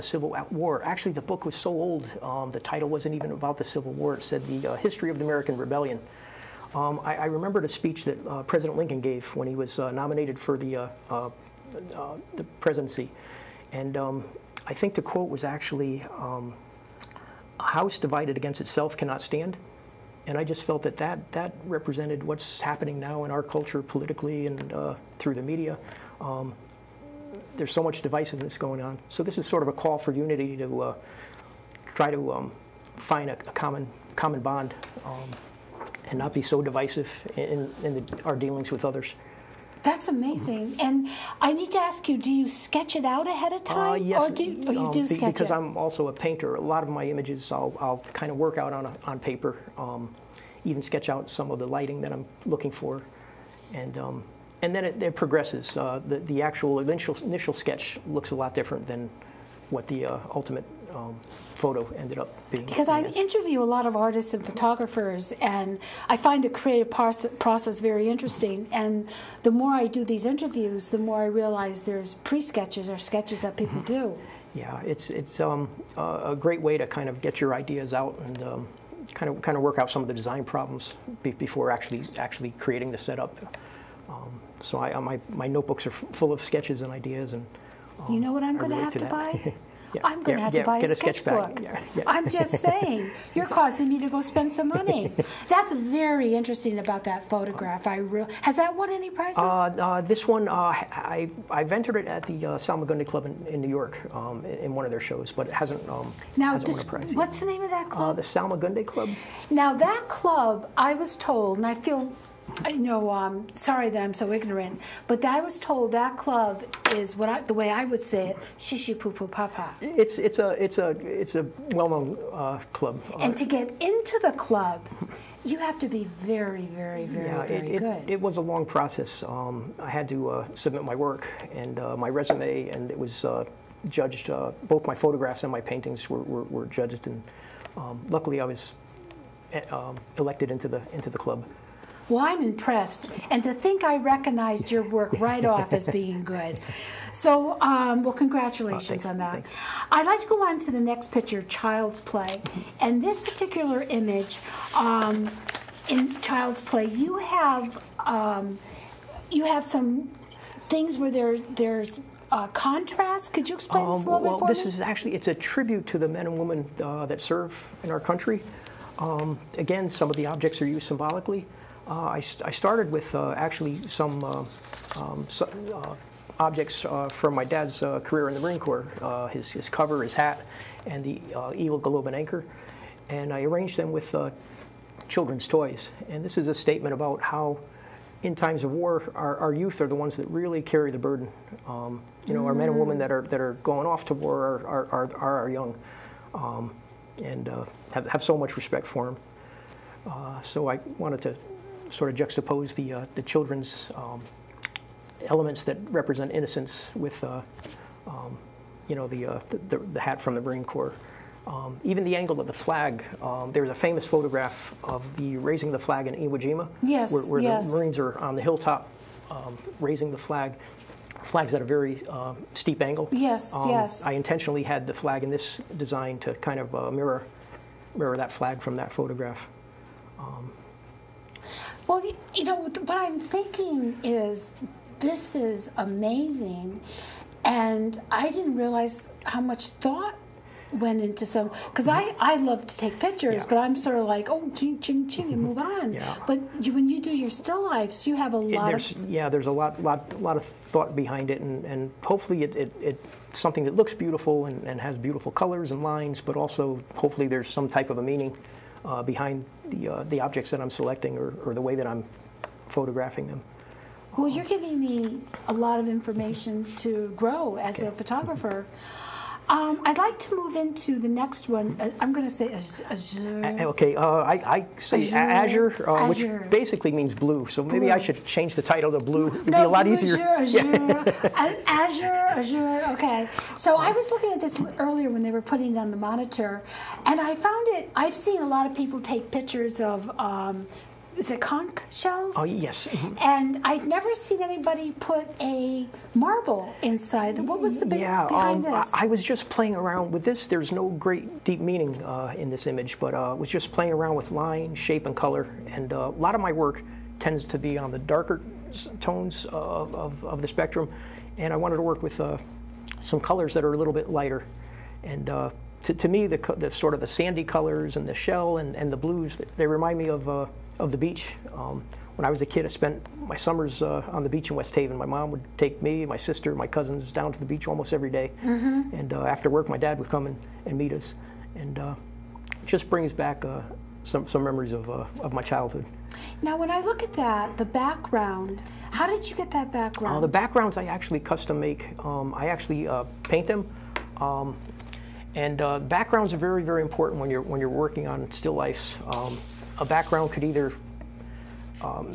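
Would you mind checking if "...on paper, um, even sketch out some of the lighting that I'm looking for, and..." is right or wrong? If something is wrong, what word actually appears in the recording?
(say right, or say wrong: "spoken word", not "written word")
right.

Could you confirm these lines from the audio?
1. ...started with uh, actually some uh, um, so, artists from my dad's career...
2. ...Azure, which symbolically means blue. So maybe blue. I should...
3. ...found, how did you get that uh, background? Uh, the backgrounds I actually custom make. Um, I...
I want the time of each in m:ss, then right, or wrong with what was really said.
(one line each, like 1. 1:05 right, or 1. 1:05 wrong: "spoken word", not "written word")
1. 2:52 wrong: "objects", not "artists"
2. 4:36 wrong: "basically", not "symbolically"
3. 5:37 wrong: "background", not "found".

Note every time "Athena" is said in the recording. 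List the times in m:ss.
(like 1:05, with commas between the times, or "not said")
not said.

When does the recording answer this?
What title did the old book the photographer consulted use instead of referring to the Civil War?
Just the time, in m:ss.
0:04.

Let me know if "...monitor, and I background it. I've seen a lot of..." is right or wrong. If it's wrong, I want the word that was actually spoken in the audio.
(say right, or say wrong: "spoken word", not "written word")
wrong: "found", not "background".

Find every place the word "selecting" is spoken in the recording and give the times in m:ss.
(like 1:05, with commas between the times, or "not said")
4:20.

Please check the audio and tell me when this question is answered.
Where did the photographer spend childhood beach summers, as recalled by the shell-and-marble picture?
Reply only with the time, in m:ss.
5:24.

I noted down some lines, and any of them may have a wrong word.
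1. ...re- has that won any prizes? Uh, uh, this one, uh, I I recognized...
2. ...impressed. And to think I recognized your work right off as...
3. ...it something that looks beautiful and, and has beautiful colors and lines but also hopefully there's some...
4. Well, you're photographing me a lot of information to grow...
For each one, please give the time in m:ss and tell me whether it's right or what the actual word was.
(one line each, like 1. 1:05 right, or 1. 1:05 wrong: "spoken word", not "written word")
1. 1:37 wrong: "entered", not "recognized"
2. 2:22 right
3. 4:12 right
4. 4:24 wrong: "giving", not "photographing".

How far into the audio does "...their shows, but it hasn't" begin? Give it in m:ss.
1:44.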